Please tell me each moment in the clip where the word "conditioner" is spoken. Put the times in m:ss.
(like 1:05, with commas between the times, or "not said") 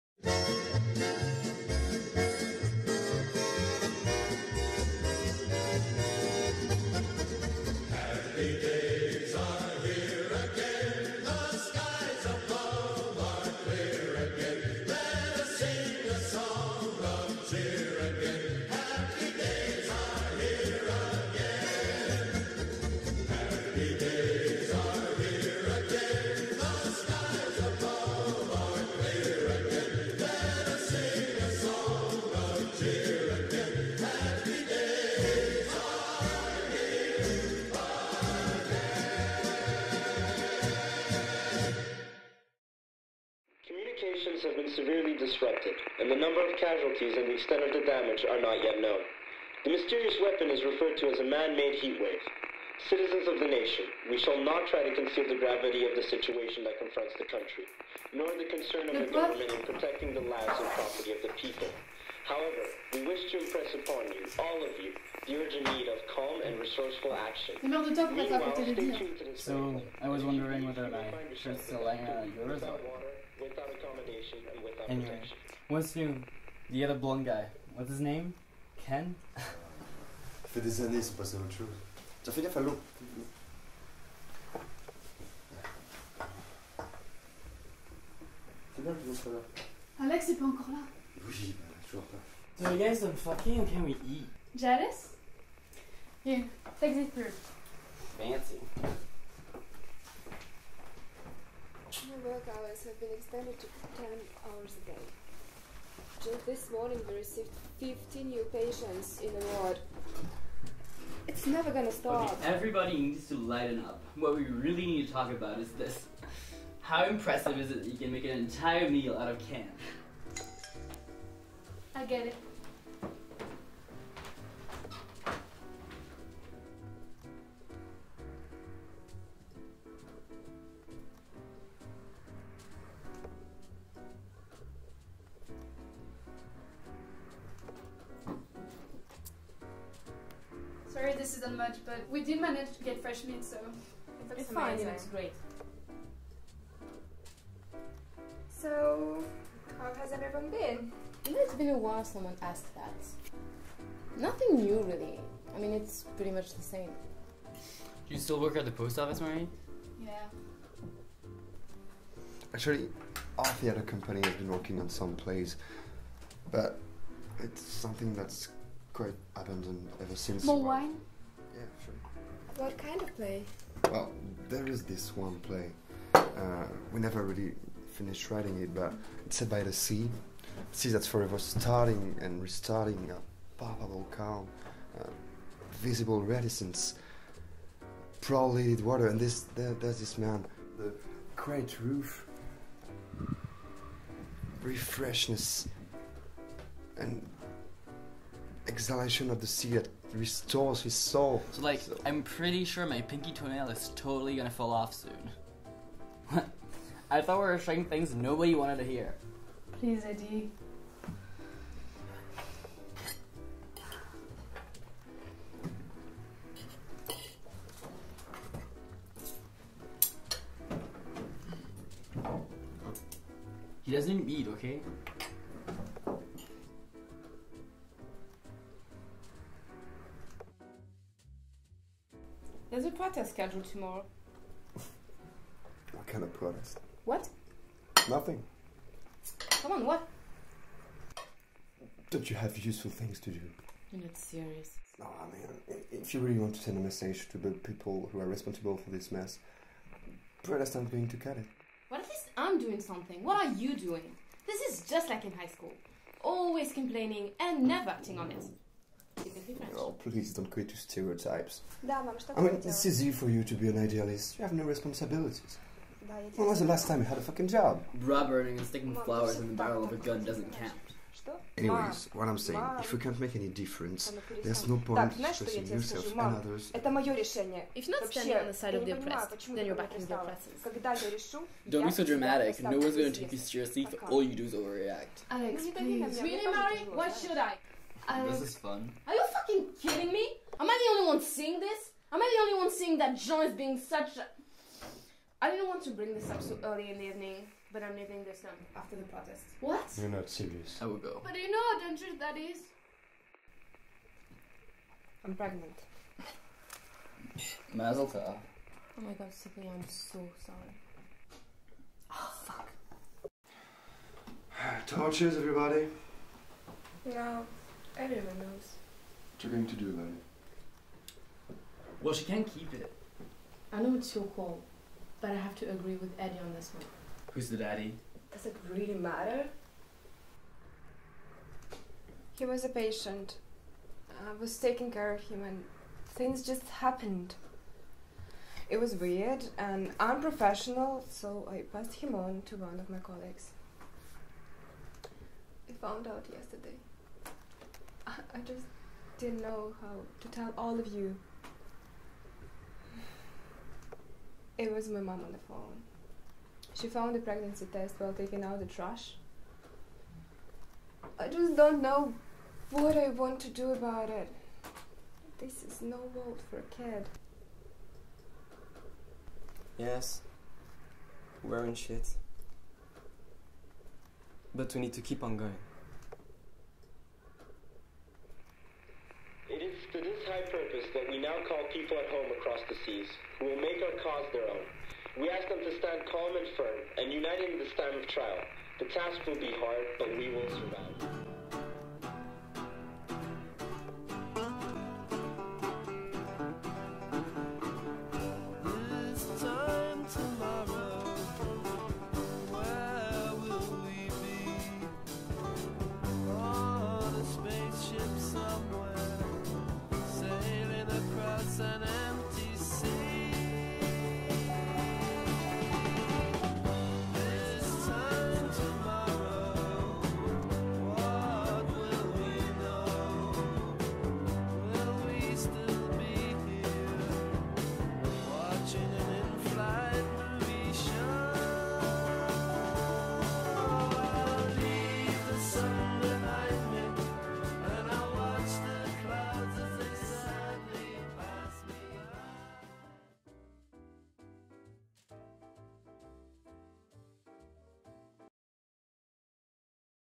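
not said.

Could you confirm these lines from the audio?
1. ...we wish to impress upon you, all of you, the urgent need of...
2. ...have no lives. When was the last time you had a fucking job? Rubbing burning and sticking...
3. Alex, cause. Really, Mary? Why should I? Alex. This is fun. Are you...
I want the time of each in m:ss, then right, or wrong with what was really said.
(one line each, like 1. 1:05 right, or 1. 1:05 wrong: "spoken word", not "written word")
1. 1:02 right
2. 4:24 wrong: "responsibilities", not "lives"
3. 4:45 wrong: "please", not "cause".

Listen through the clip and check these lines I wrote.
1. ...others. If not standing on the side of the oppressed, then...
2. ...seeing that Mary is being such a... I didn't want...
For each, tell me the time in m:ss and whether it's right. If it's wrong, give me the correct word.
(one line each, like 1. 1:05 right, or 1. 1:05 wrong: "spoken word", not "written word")
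1. 4:36 right
2. 4:52 wrong: "John", not "Mary".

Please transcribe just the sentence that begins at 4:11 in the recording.
Well, at least I'm doing something.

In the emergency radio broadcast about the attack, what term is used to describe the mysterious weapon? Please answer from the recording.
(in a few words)
man-made heat wave.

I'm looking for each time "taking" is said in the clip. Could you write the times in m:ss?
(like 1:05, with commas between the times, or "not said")
5:34, 5:58.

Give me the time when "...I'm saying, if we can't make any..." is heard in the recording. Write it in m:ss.
4:32.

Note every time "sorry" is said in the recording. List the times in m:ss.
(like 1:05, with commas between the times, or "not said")
2:20, 5:10.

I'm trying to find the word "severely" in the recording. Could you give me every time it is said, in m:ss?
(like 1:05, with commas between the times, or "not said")
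0:44.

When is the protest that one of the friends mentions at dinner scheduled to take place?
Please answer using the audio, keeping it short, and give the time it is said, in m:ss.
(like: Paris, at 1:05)
tomorrow, at 3:53.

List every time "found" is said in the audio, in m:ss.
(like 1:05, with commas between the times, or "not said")
5:45, 5:56.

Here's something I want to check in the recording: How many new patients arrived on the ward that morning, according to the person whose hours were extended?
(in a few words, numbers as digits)
50.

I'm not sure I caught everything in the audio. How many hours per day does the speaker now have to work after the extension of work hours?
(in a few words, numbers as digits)
10.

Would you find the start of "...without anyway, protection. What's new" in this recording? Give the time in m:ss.
1:14.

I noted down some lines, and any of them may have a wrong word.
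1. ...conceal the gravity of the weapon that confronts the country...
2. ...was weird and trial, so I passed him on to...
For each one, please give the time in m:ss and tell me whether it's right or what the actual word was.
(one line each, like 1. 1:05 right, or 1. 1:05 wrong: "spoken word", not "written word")
1. 0:54 wrong: "situation", not "weapon"
2. 5:38 wrong: "unprofessional", not "trial".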